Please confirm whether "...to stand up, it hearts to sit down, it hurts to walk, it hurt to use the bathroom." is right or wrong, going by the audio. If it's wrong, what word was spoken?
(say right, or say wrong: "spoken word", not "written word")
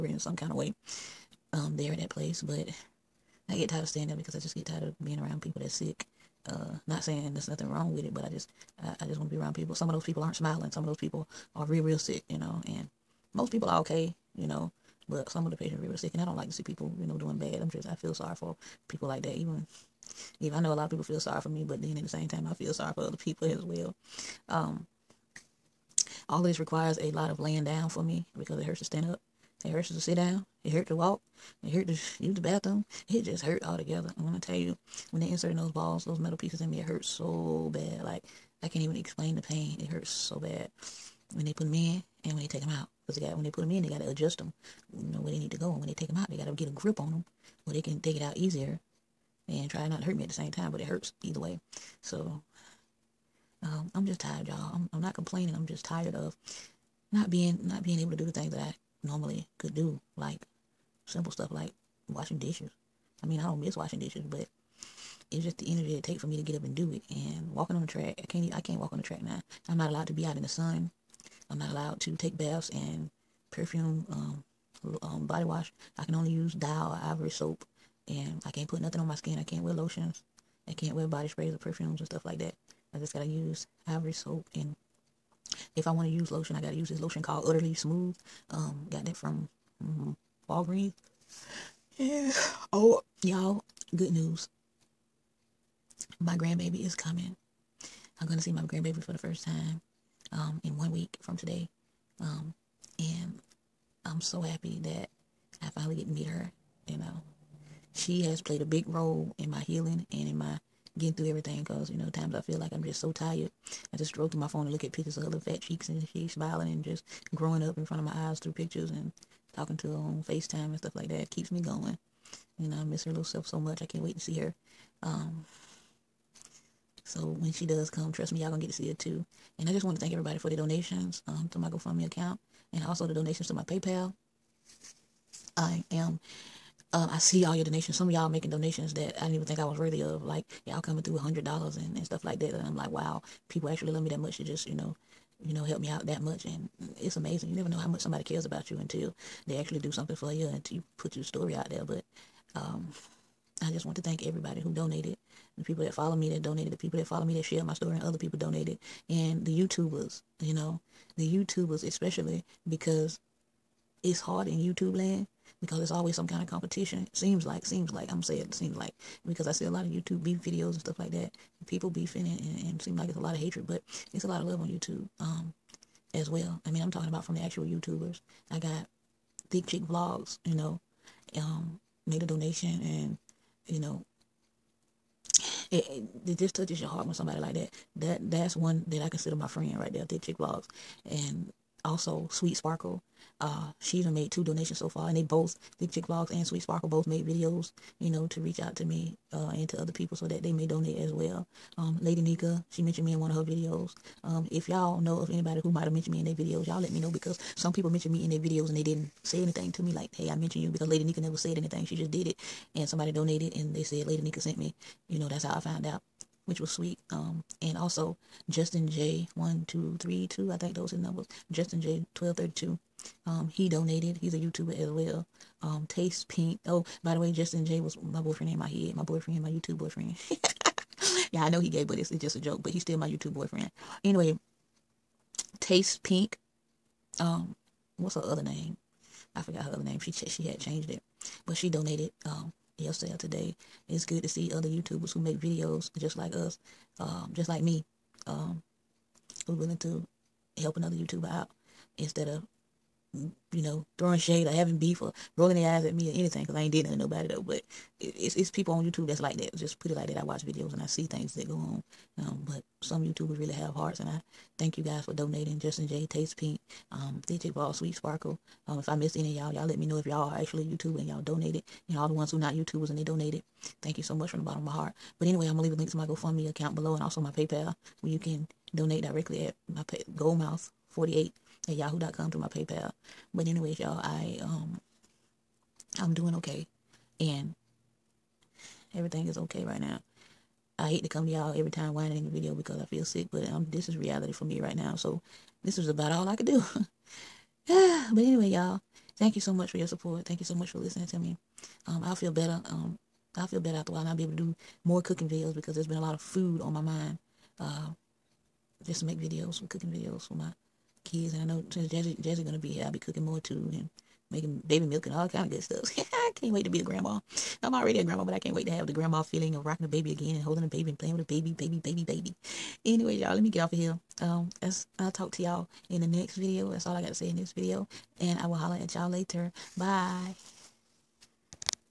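wrong: "hurts", not "hearts".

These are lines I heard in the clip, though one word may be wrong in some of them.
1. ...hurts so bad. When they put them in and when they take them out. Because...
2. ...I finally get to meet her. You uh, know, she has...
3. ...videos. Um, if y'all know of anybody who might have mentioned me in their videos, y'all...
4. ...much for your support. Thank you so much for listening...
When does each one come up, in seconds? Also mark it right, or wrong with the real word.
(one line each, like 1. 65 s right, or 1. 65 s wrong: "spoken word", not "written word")
1. 39 s right
2. 105 s right
3. 203 s right
4. 299 s right.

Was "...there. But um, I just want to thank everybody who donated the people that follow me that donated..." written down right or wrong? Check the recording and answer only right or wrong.
right.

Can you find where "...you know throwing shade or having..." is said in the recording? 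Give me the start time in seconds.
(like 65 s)
253 s.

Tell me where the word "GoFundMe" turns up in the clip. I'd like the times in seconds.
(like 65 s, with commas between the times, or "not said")
131 s, 276 s.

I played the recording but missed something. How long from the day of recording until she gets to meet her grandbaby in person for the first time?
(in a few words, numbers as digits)
1 week.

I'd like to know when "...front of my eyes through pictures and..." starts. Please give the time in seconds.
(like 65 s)
117 s.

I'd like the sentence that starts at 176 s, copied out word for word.
I mean, I'm talking about from the actual YouTubers.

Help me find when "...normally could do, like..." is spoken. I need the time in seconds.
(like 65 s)
59 s.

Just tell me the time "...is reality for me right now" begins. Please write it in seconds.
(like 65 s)
293 s.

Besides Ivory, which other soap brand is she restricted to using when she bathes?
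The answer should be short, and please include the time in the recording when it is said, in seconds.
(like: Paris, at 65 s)
Dial, at 76 s.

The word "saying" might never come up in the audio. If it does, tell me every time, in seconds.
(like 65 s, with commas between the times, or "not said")
7 s, 168 s.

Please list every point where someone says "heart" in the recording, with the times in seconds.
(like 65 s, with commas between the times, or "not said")
186 s, 263 s, 274 s.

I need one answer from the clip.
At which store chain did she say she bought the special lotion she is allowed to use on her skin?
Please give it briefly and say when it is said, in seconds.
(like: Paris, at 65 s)
Walgreens, at 90 s.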